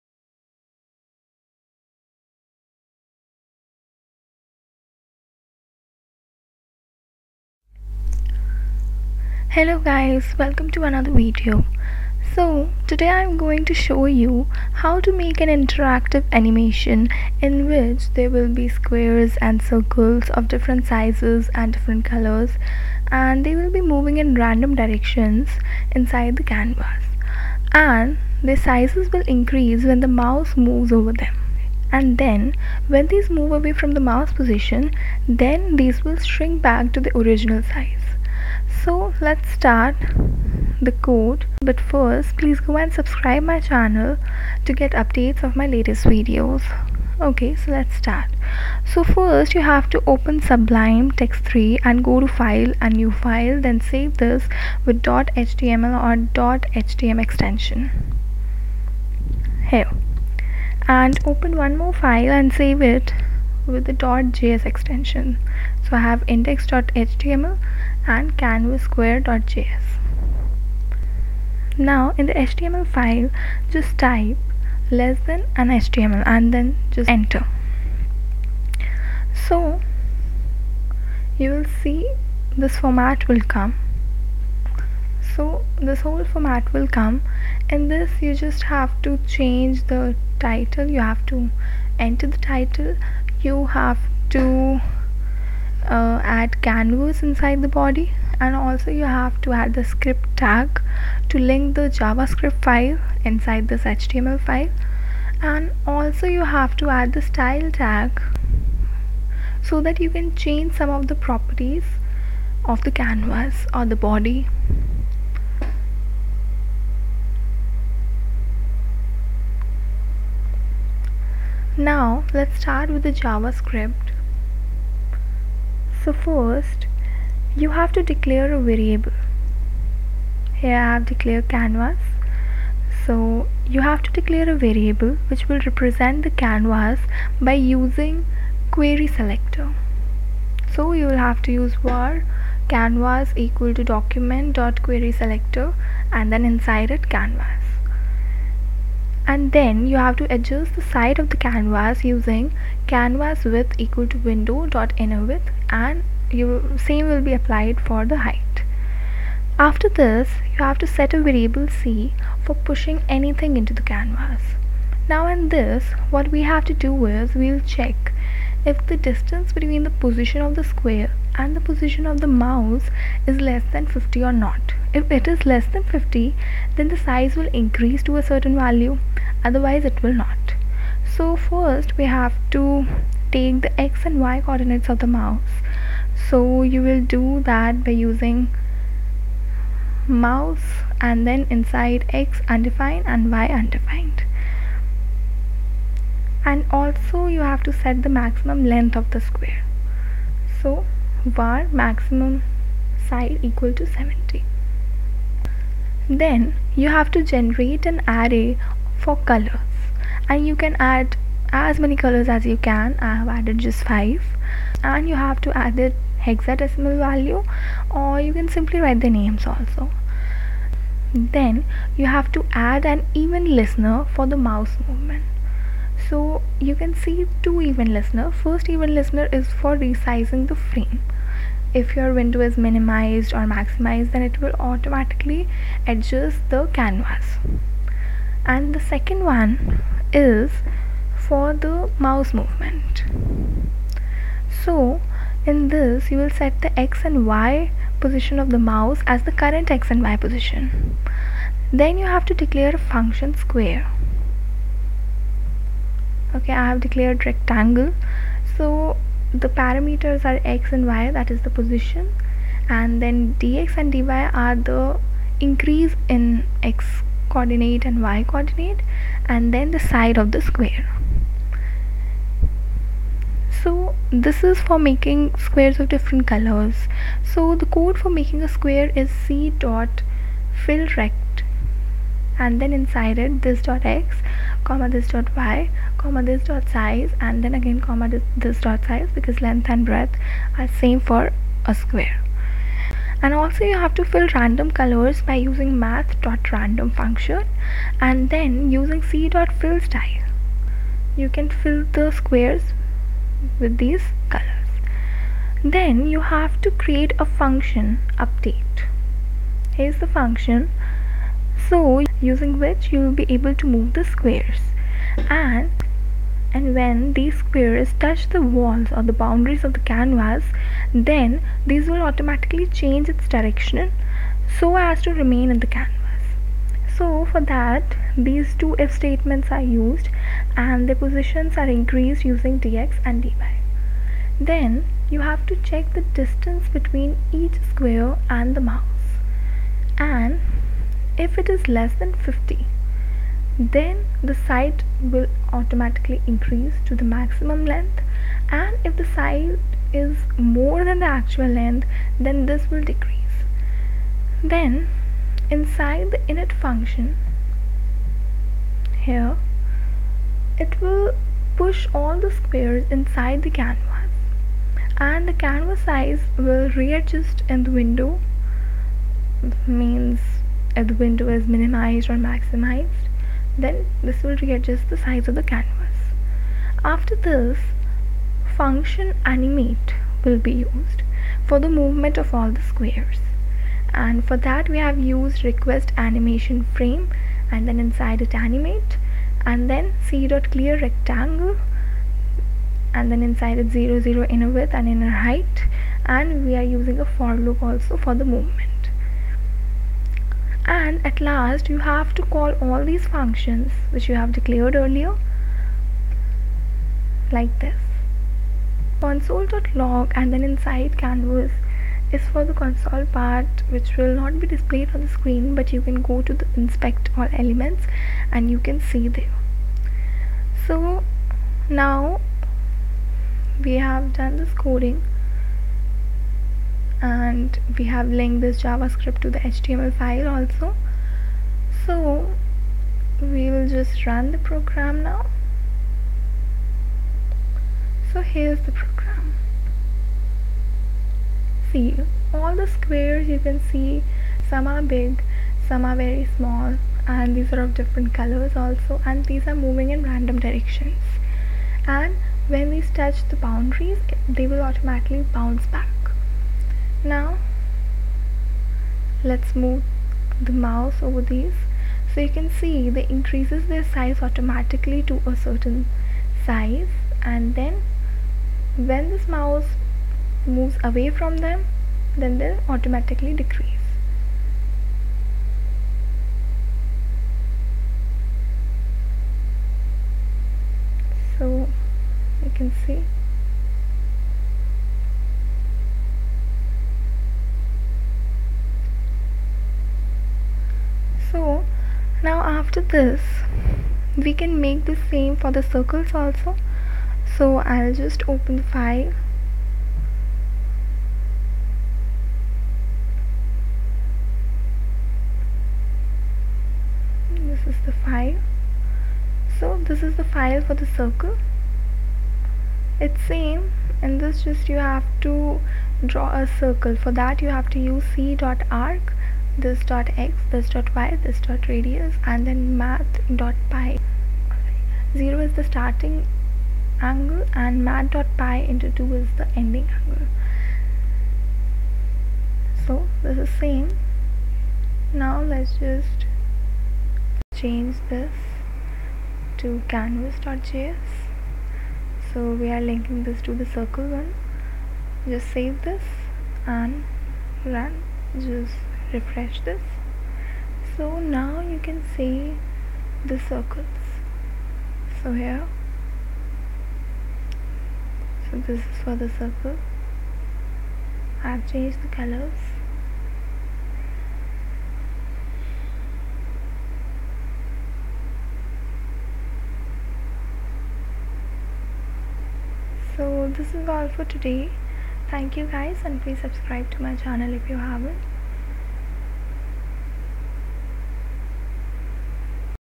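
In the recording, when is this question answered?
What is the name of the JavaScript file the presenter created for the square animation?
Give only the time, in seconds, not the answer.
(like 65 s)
68 s.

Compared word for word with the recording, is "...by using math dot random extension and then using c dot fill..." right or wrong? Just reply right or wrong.
wrong.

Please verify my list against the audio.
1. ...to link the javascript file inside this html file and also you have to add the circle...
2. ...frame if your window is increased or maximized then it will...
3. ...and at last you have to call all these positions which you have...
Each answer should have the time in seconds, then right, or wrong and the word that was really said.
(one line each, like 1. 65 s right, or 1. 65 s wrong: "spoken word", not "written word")
1. 101 s wrong: "style", not "circle"
2. 230 s wrong: "minimized", not "increased"
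3. 400 s wrong: "functions", not "positions".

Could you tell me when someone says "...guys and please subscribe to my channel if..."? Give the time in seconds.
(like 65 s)
575 s.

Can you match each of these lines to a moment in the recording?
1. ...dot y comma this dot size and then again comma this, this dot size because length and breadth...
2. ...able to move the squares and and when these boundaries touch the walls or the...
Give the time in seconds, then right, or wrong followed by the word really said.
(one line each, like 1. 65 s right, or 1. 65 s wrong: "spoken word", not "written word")
1. 285 s right
2. 313 s wrong: "squares", not "boundaries".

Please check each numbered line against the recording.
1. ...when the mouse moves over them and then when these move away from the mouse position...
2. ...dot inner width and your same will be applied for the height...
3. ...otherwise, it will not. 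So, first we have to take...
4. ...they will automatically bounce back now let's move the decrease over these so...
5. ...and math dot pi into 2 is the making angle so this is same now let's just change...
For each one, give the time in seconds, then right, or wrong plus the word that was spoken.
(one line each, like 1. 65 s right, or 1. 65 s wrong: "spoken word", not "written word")
1. 29 s right
2. 154 s right
3. 179 s right
4. 454 s wrong: "mouse", not "decrease"
5. 527 s wrong: "ending", not "making".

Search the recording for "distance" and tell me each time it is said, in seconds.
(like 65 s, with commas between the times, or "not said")
168 s, 336 s.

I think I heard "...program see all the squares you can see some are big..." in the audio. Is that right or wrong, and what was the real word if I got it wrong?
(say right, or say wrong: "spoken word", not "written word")
right.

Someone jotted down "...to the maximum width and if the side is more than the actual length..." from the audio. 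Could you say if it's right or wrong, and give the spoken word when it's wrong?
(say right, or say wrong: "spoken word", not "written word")
wrong: "length", not "width".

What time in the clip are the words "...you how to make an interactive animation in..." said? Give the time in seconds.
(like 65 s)
14 s.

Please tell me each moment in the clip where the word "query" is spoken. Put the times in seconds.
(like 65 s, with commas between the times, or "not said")
138 s, 144 s.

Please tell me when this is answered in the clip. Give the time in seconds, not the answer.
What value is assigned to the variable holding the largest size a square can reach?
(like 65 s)
203 s.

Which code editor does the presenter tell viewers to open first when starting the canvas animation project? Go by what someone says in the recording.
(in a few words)
Sublime Text 3.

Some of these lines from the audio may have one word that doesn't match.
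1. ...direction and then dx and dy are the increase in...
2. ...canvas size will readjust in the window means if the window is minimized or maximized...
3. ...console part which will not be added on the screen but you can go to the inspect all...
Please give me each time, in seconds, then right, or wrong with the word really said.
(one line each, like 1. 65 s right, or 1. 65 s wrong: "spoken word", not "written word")
1. 261 s wrong: "position", not "direction"
2. 365 s right
3. 412 s wrong: "displayed", not "added".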